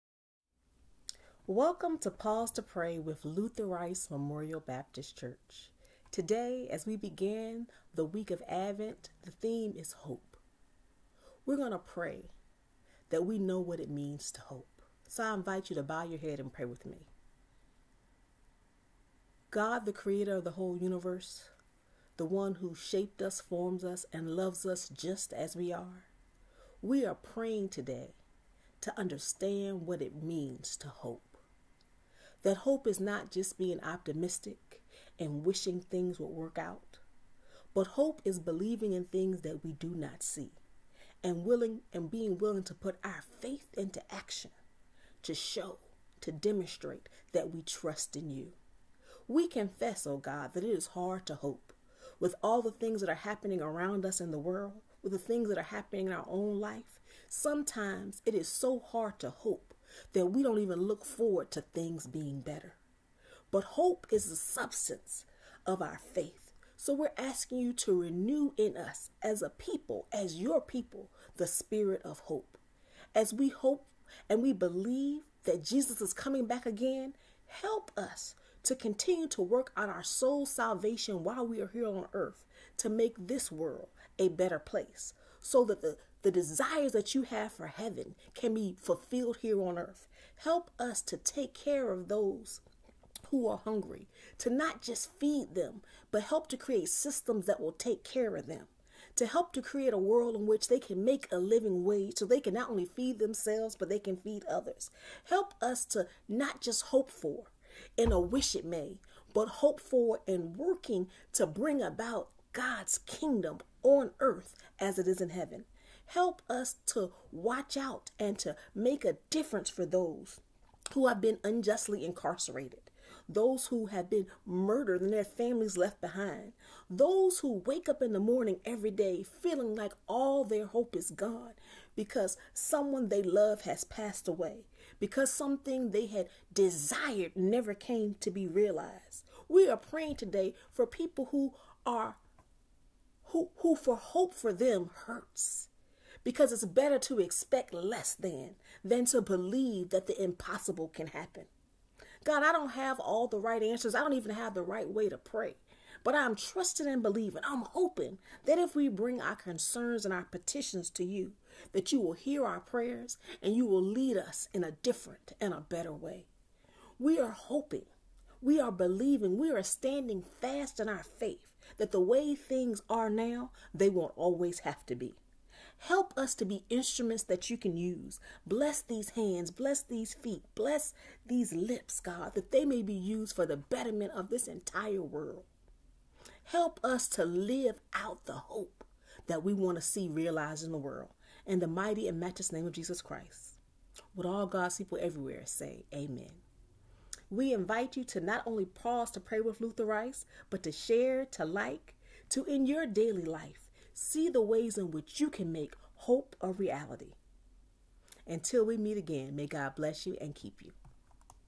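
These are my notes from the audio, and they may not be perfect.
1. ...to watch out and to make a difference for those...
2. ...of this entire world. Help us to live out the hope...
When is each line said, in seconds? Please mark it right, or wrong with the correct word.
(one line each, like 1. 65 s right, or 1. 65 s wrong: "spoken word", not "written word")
1. 116 s right
2. 184 s right.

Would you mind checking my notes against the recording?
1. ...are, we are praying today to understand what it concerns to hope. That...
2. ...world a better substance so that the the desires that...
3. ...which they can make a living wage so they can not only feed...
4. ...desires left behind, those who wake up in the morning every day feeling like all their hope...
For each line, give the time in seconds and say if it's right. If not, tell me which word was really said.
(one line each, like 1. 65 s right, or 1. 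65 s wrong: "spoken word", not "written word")
1. 25 s wrong: "means", not "concerns"
2. 83 s wrong: "place", not "substance"
3. 100 s right
4. 125 s wrong: "families", not "desires".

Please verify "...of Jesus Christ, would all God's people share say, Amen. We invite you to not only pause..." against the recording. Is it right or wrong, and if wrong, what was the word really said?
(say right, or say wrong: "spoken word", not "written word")
wrong: "everywhere", not "share".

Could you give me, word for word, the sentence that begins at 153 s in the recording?
I don't even have the right way to pray.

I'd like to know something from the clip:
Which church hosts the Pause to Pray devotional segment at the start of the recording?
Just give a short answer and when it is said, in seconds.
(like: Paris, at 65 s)
Luther Rice Memorial Baptist Church, at 3 s.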